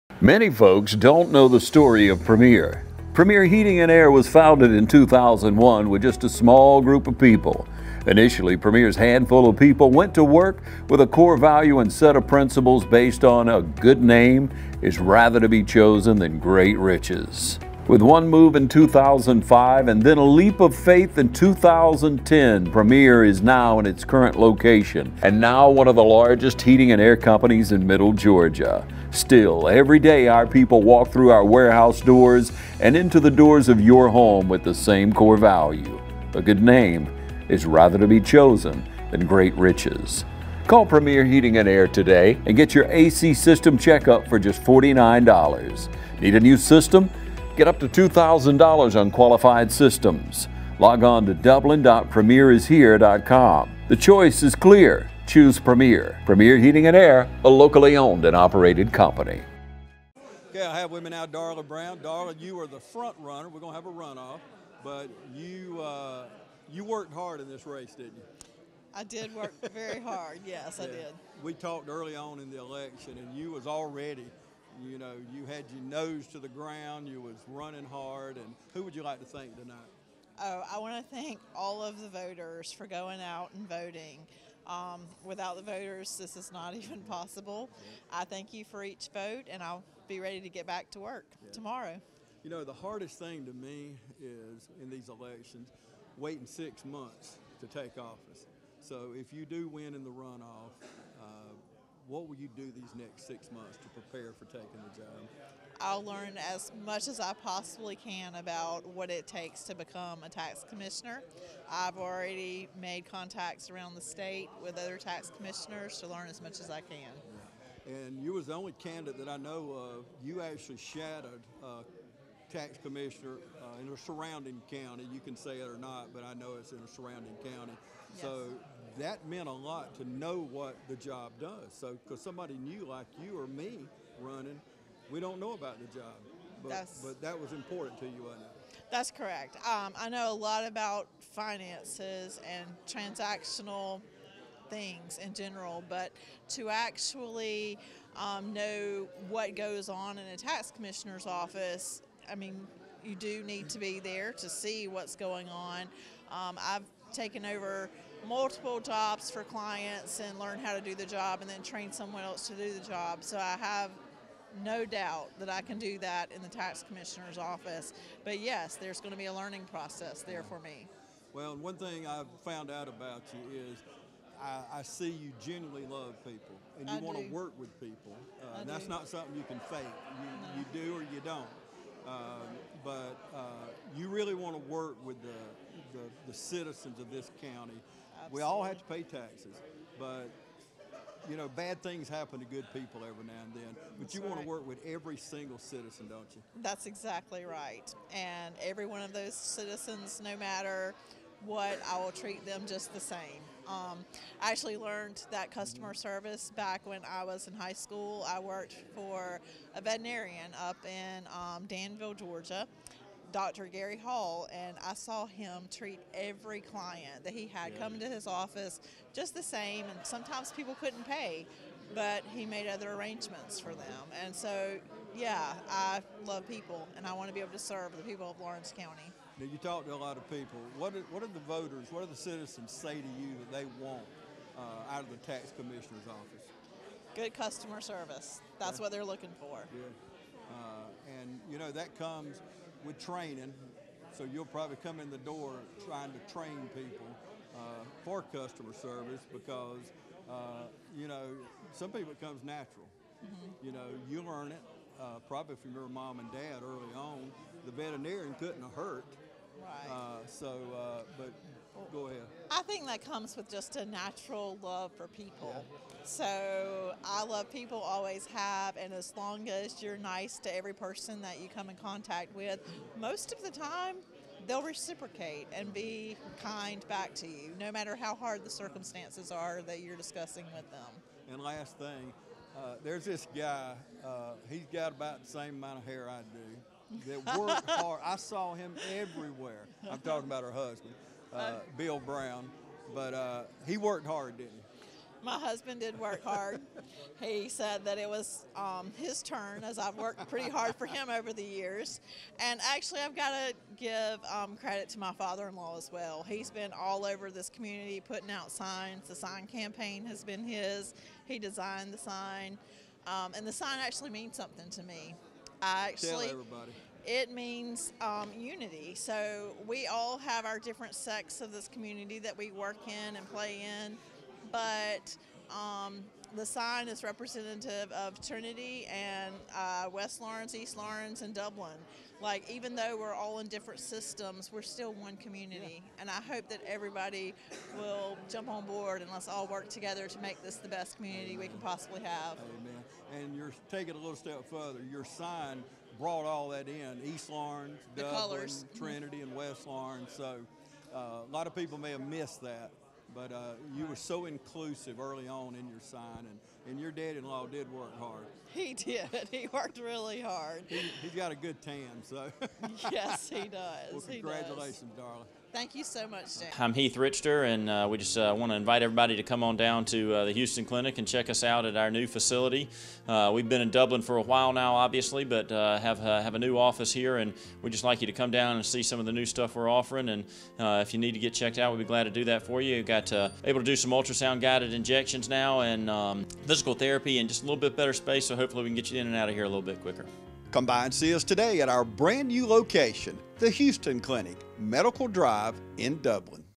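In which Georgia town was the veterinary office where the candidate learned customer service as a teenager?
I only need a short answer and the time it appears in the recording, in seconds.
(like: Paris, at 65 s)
Danville, at 211 s.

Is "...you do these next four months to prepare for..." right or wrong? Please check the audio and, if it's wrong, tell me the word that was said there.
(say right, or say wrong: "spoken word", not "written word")
wrong: "six", not "four".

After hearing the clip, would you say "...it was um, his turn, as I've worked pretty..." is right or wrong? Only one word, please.
right.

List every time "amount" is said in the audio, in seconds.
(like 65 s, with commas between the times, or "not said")
285 s.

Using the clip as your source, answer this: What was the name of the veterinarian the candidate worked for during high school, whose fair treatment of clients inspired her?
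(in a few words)
Dr. Gary Hall.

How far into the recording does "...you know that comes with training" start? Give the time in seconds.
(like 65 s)
241 s.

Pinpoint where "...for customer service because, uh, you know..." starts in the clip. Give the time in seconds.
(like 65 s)
248 s.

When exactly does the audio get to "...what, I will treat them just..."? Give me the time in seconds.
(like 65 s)
201 s.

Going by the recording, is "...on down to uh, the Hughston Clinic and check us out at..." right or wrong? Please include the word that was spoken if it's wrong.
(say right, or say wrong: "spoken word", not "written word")
right.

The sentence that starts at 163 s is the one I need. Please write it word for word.
So I have no doubt that I can do that in the tax commissioner's office.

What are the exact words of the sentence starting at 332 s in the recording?
Like, even though we're all in different systems, we're still one community.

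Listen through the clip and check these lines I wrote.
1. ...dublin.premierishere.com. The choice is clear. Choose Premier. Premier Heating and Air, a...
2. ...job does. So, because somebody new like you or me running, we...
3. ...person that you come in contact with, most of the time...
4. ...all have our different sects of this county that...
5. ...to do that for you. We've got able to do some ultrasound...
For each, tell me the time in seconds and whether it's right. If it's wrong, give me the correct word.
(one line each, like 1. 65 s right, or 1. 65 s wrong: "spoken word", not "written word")
1. 51 s right
2. 130 s right
3. 270 s right
4. 319 s wrong: "community", not "county"
5. 382 s right.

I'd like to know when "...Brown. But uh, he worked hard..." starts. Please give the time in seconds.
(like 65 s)
291 s.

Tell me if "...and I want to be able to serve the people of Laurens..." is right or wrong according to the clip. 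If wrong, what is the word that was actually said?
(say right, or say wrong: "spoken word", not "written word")
right.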